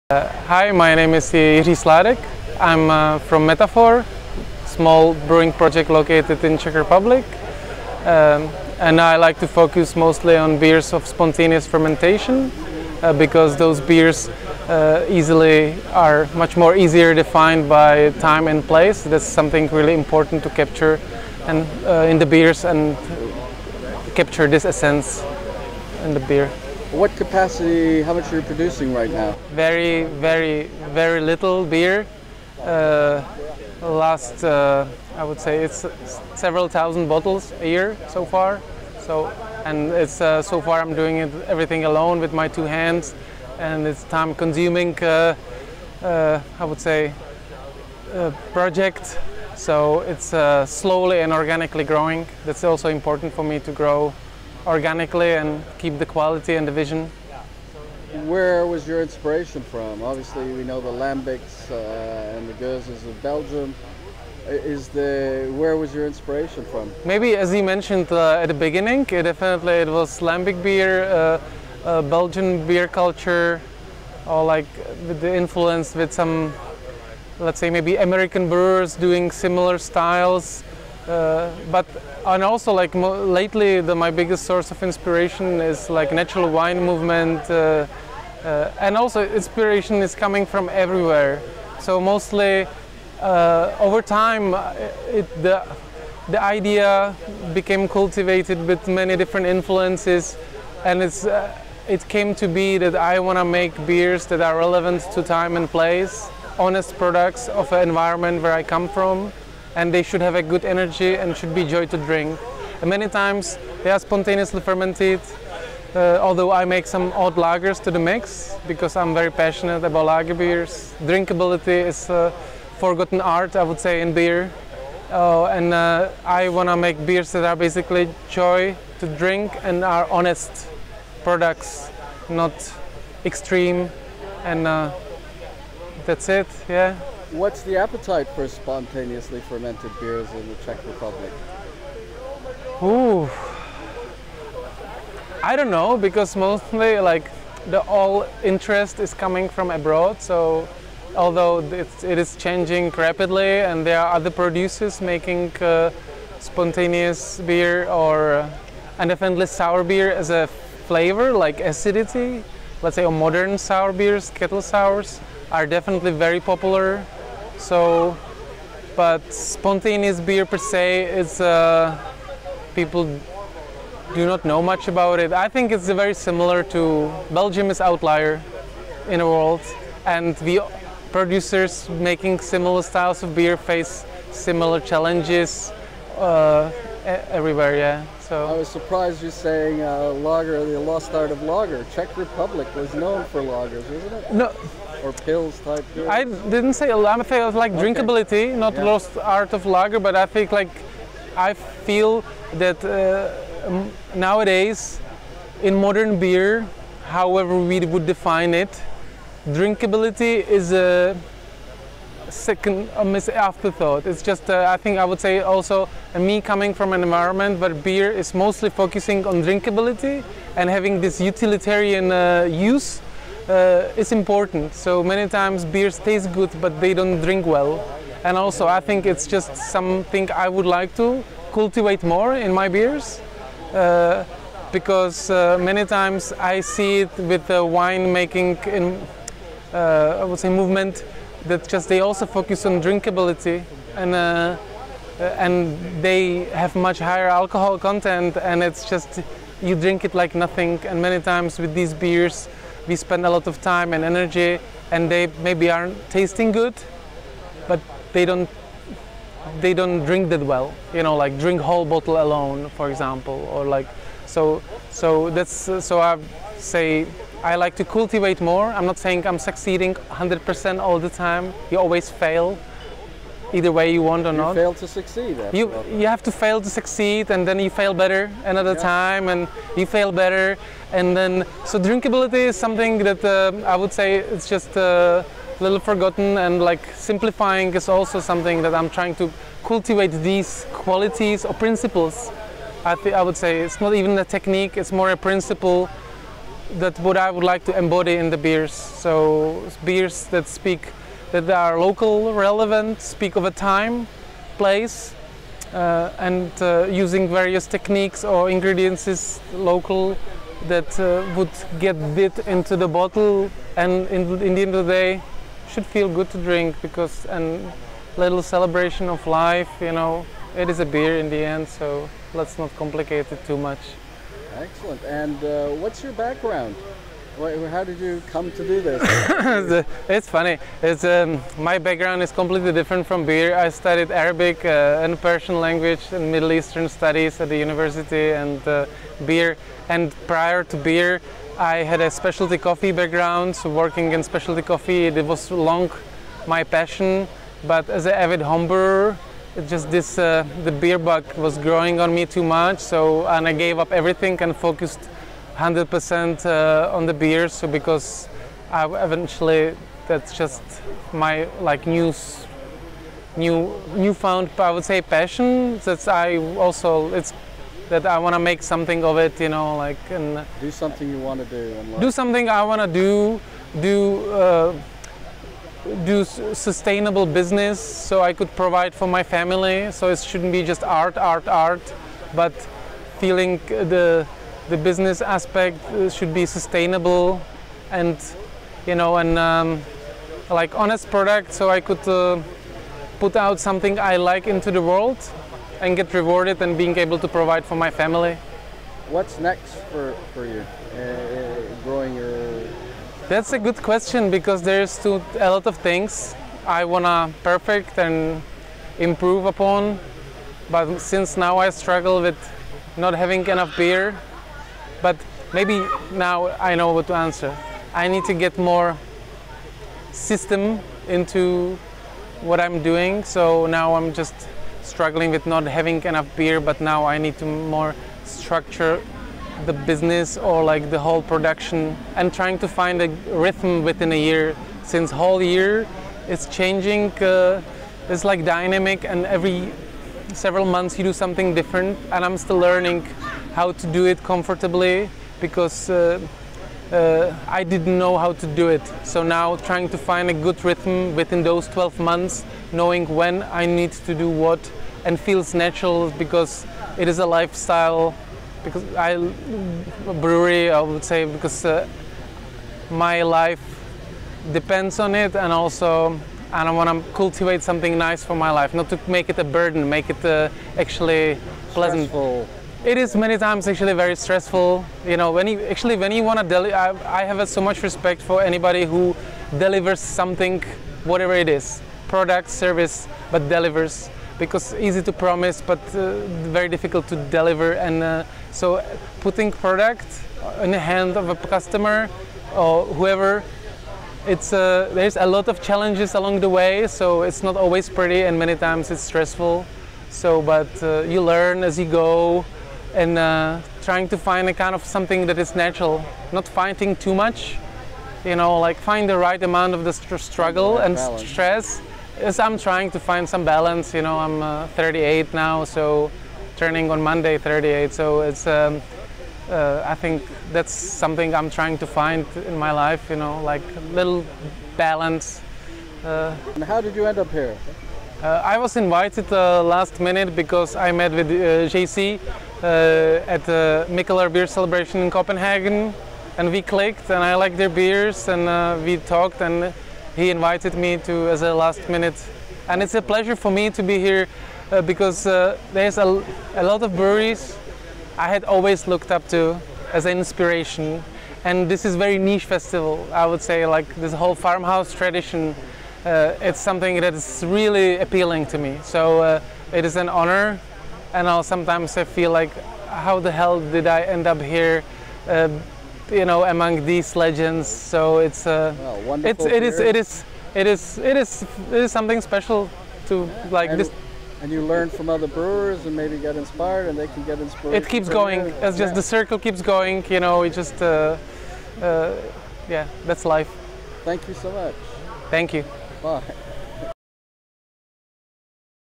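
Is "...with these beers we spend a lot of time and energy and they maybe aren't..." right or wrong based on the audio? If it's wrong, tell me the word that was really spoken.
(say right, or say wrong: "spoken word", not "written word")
right.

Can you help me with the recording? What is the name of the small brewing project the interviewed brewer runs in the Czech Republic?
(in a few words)
Métaphore.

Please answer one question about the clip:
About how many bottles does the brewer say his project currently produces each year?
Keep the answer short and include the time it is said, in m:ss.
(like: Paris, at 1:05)
several thousand bottles, at 0:36.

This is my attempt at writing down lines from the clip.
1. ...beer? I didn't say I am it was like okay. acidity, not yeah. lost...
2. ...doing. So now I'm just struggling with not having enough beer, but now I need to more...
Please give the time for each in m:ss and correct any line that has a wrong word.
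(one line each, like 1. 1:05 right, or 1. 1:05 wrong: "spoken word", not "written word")
1. 3:15 wrong: "drinkability", not "acidity"
2. 7:02 right.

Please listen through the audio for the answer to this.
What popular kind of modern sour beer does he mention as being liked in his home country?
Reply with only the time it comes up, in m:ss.
2:44.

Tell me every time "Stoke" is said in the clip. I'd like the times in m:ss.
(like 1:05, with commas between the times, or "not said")
not said.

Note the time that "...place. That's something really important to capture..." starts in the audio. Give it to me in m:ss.
0:18.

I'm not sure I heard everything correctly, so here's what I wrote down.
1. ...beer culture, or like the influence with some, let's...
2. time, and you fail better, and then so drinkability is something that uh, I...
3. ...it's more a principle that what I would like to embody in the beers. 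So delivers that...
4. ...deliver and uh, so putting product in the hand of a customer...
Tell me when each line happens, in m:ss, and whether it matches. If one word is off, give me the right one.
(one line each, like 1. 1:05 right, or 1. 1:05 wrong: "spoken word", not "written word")
1. 1:12 right
2. 4:38 right
3. 4:54 wrong: "beers", not "delivers"
4. 8:07 right.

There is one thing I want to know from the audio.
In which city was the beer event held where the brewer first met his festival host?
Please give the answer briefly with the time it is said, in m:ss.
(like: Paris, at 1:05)
Copenhagen, at 8:55.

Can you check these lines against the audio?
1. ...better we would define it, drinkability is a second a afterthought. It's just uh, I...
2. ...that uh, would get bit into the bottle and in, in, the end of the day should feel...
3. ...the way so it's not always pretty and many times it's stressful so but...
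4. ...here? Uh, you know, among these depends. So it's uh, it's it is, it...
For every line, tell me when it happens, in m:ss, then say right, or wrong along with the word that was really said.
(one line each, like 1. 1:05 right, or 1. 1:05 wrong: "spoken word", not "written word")
1. 3:27 wrong: "however", not "better"
2. 5:10 right
3. 8:16 right
4. 9:24 wrong: "legends", not "depends".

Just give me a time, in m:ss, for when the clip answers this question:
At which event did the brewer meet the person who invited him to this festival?
8:53.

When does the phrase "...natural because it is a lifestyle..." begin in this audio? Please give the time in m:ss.
7:35.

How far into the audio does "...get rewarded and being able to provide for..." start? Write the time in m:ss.
6:35.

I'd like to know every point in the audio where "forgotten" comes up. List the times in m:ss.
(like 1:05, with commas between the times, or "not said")
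2:02, 4:45.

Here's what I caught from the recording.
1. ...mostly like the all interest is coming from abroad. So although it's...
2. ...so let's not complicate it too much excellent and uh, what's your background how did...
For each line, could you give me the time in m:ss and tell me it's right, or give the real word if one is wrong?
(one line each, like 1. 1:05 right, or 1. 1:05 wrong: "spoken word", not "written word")
1. 2:26 right
2. 5:21 right.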